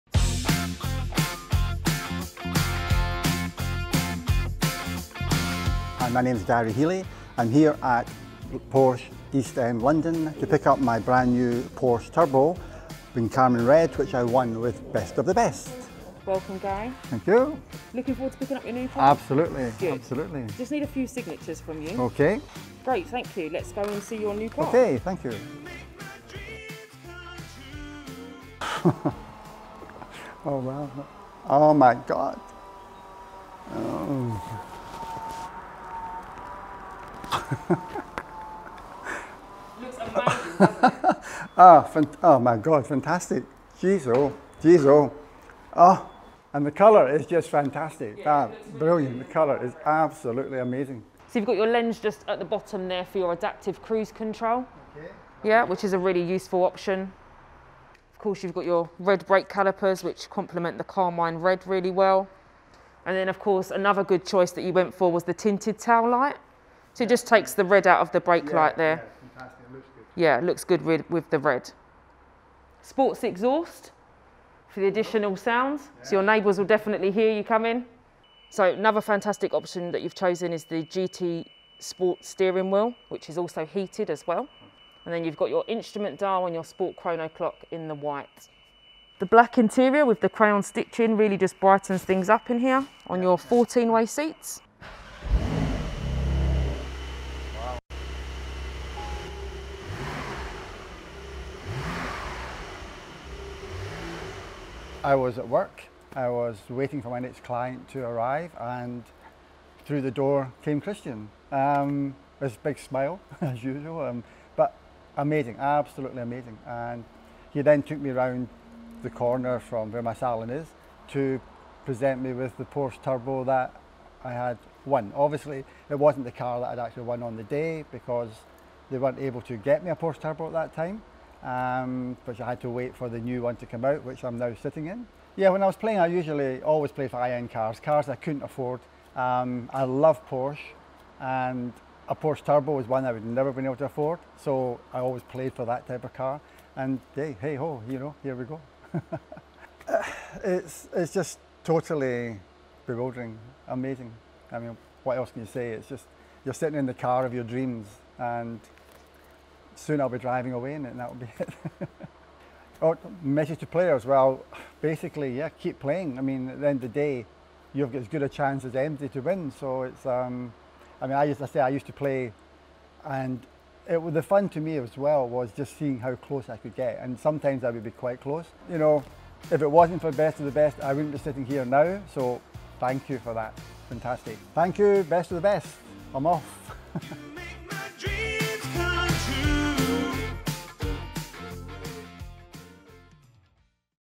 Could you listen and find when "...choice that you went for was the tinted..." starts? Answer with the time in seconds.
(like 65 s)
64 s.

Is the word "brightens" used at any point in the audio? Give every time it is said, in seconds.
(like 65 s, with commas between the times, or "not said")
91 s.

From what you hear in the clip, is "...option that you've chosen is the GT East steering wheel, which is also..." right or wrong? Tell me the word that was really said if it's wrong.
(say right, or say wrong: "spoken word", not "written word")
wrong: "Sport", not "East".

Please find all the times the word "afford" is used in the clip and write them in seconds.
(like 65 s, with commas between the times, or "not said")
138 s, 143 s.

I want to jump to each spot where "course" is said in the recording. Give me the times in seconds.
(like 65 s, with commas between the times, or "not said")
58 s, 63 s.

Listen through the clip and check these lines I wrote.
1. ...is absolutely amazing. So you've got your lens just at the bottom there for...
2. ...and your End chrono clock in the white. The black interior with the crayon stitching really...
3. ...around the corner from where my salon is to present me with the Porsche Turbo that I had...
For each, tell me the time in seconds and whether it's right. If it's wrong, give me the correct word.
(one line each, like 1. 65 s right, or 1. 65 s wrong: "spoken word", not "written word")
1. 49 s right
2. 86 s wrong: "Sport", not "End"
3. 118 s right.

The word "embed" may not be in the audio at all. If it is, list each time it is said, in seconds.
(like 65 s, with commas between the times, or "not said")
not said.